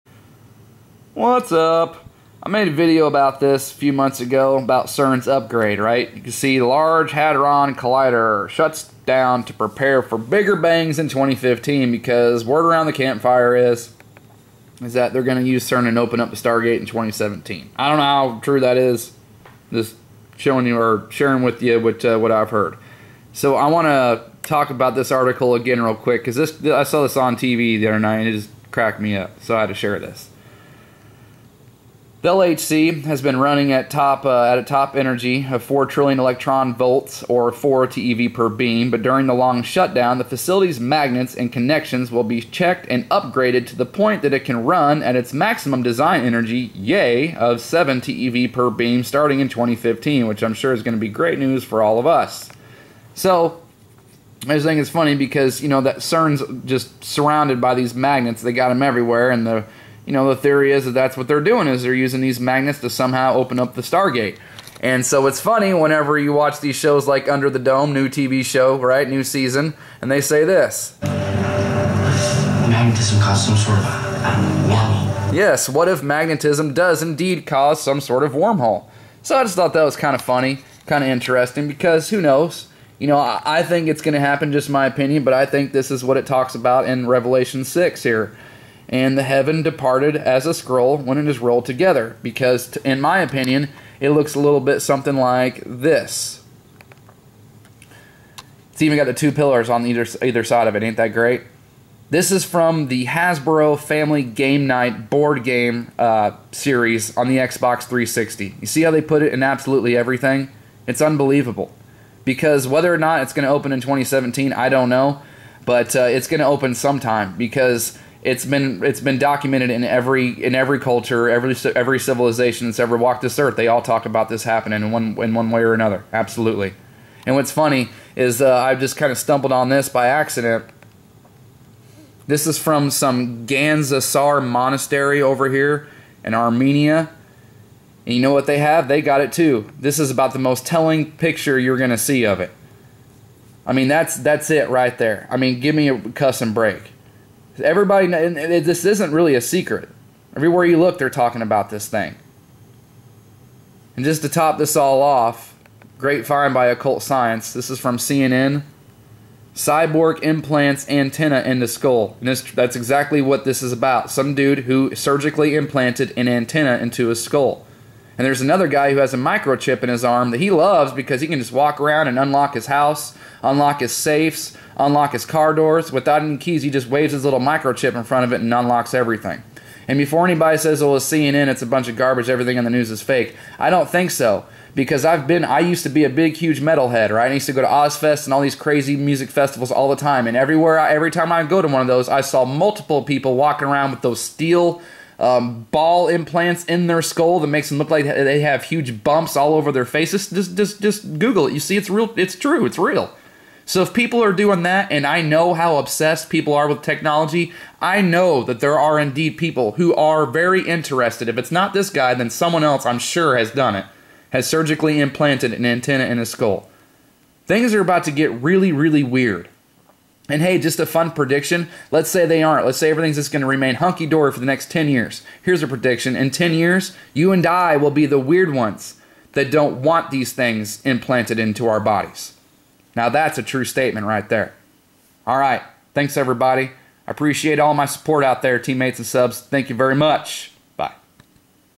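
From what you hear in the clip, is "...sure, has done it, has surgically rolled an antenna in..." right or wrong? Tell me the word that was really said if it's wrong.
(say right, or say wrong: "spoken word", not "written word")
wrong: "implanted", not "rolled".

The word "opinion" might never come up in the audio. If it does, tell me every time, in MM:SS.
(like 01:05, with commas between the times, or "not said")
01:24, 01:33.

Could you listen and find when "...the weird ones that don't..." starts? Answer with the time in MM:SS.
03:48.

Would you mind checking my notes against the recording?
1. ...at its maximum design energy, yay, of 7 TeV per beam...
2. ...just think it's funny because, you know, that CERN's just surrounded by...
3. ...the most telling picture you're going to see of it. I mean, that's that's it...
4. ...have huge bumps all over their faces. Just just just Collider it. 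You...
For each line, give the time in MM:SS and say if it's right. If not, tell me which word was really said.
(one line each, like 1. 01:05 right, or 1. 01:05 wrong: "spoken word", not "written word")
1. 00:45 right
2. 00:54 right
3. 02:20 right
4. 03:18 wrong: "Google", not "Collider".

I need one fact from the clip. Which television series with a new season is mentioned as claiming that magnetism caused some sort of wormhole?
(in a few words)
Under the Dome.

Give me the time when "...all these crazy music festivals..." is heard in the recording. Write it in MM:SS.
03:08.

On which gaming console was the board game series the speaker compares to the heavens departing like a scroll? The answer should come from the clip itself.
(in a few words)
Xbox 360.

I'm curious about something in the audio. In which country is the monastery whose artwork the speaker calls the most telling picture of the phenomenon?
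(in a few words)
Armenia.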